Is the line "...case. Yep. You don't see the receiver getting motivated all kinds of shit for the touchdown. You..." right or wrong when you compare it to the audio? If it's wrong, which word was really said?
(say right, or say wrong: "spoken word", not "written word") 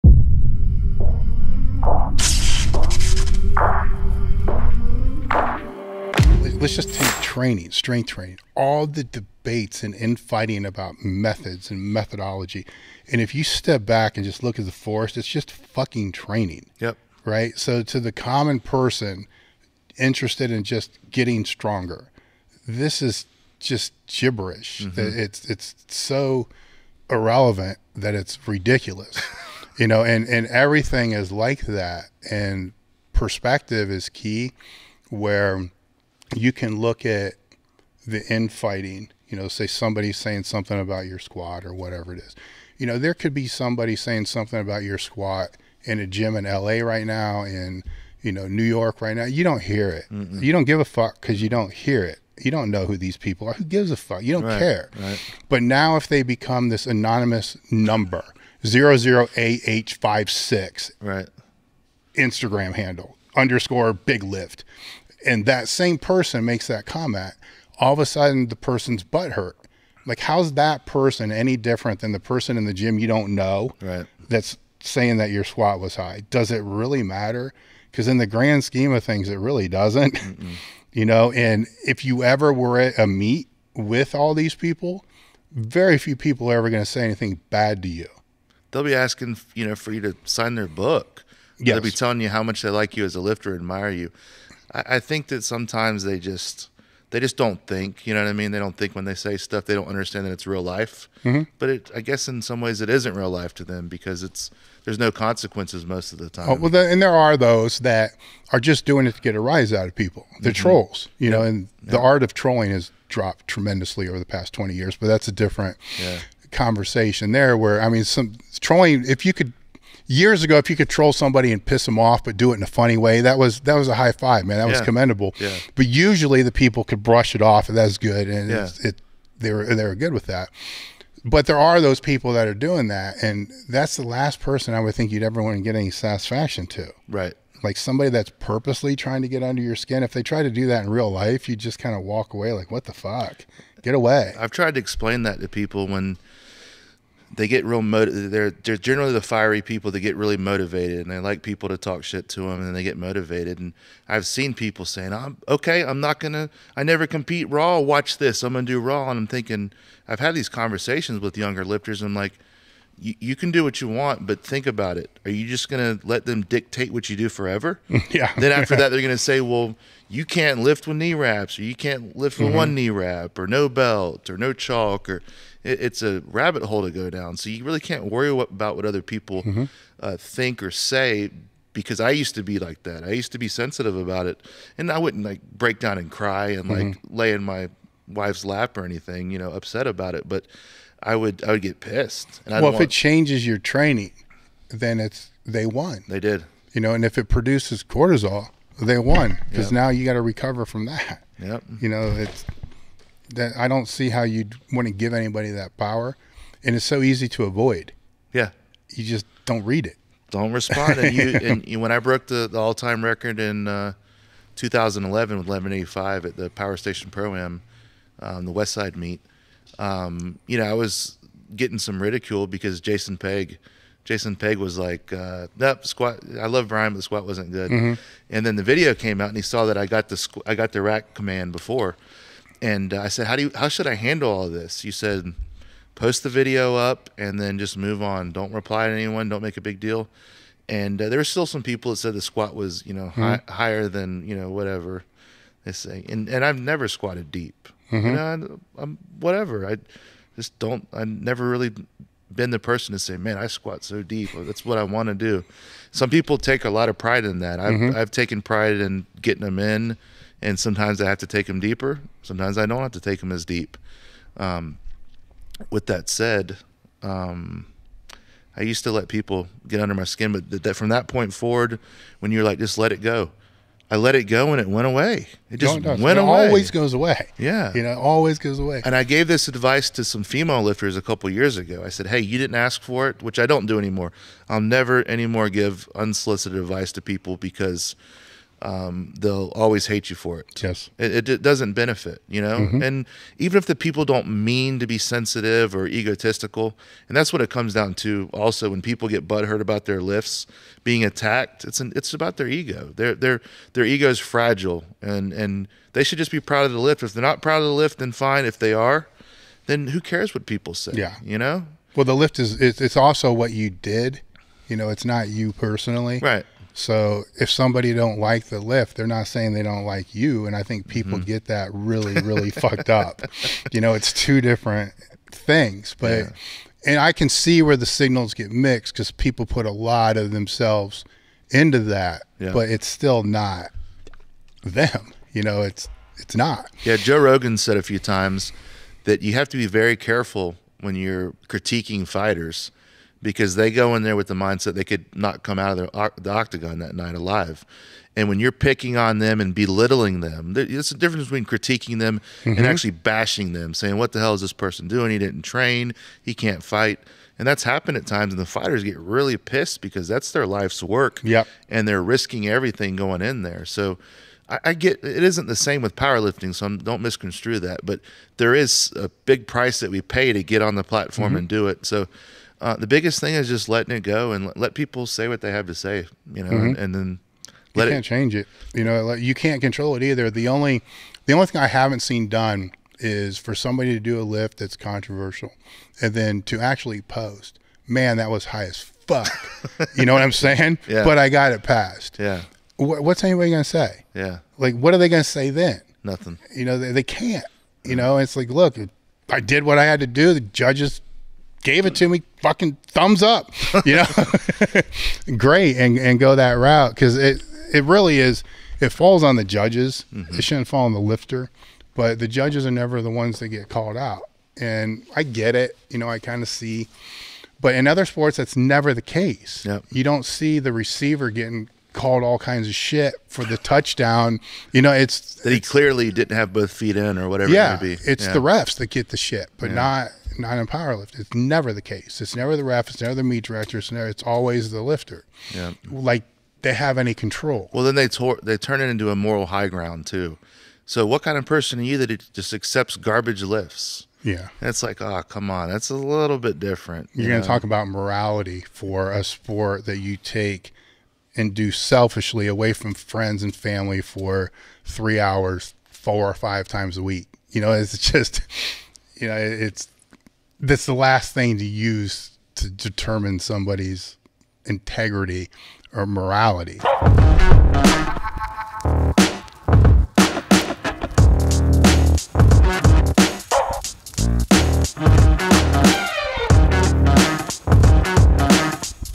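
wrong: "called", not "motivated".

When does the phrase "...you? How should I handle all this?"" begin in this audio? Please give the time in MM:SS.
03:53.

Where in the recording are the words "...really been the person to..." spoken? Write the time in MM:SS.
04:11.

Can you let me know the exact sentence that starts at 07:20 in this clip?
So what kind of person are you that just accepts garbage lifts?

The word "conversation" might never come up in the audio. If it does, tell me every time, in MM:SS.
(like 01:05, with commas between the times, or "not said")
01:56, 02:40.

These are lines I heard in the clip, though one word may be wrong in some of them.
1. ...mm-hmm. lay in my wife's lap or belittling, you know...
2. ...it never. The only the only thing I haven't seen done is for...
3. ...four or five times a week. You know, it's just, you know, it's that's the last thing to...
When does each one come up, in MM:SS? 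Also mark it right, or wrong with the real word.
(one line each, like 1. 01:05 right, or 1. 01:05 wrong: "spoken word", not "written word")
1. 03:06 wrong: "anything", not "belittling"
2. 06:19 wrong: "either", not "never"
3. 07:35 right.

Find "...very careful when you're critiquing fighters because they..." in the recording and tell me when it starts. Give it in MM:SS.
05:39.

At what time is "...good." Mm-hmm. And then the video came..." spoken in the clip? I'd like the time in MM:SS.
03:47.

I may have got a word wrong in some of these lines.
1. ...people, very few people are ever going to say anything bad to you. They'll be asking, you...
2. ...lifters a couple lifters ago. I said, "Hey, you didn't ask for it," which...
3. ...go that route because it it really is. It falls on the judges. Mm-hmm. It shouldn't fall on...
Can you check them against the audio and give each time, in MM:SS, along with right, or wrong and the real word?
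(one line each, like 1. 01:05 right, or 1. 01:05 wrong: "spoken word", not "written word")
1. 01:24 right
2. 04:40 wrong: "years", not "lifters"
3. 06:46 right.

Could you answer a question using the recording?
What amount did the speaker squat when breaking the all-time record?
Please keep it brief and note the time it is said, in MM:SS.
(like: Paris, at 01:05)
1185, at 03:35.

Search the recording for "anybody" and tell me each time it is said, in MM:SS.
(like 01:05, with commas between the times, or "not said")
03:25, 06:33.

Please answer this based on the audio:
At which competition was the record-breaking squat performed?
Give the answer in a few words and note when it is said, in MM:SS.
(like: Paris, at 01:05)
Power Station Pro Am, at 03:36.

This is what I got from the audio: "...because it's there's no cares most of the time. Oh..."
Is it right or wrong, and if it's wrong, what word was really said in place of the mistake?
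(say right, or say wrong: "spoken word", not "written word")
wrong: "consequences", not "cares".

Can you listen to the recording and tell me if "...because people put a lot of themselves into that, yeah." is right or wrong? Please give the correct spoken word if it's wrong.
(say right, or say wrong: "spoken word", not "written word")
right.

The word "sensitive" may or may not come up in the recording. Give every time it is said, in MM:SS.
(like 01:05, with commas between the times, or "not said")
03:03, 04:54.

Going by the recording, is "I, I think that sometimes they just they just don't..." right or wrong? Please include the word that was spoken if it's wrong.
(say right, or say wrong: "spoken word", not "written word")
right.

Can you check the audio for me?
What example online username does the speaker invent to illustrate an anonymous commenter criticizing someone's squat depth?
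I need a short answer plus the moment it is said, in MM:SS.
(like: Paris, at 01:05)
big lift, at 01:03.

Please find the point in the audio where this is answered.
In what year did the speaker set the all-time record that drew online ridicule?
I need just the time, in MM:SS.
03:34.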